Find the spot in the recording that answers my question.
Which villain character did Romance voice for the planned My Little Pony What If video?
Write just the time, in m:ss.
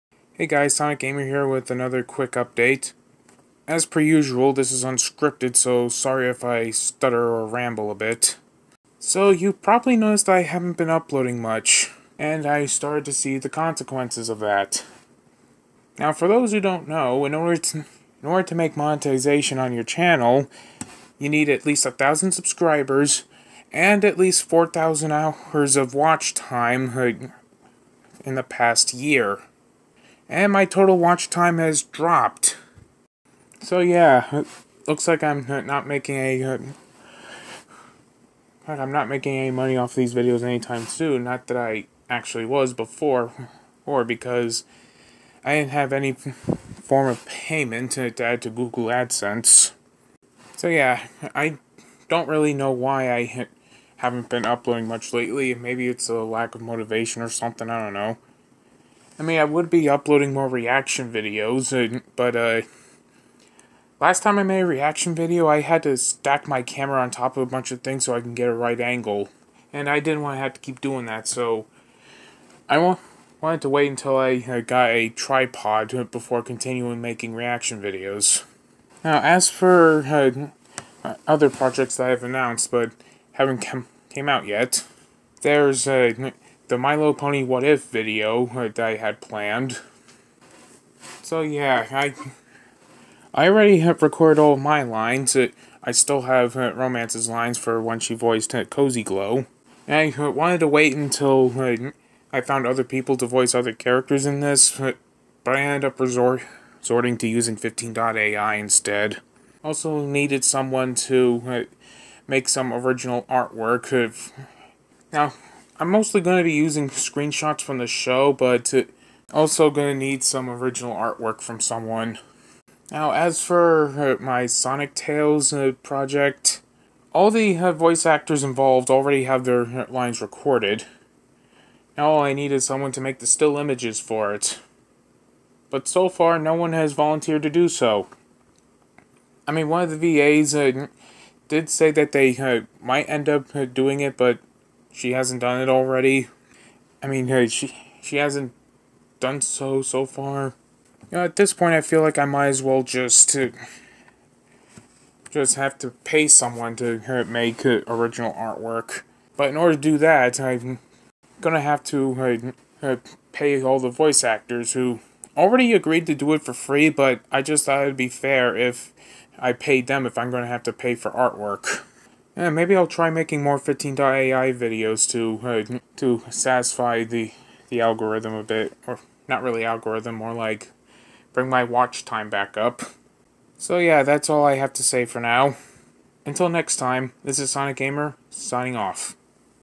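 1:38.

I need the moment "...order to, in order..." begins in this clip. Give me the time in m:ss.
0:17.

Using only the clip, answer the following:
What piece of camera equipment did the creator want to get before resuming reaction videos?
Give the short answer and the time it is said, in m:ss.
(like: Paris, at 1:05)
tripod, at 1:15.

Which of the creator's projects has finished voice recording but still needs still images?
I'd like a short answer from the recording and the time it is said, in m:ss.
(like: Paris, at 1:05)
Sonic Tales, at 2:04.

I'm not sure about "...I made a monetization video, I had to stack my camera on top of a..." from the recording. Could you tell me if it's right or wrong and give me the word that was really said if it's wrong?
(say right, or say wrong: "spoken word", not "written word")
wrong: "reaction", not "monetization".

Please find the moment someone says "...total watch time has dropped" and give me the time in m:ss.
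0:30.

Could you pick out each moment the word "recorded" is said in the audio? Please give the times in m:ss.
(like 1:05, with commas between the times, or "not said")
1:34, 2:10.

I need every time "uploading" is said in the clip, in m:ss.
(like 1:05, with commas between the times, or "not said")
0:10, 0:54, 0:59.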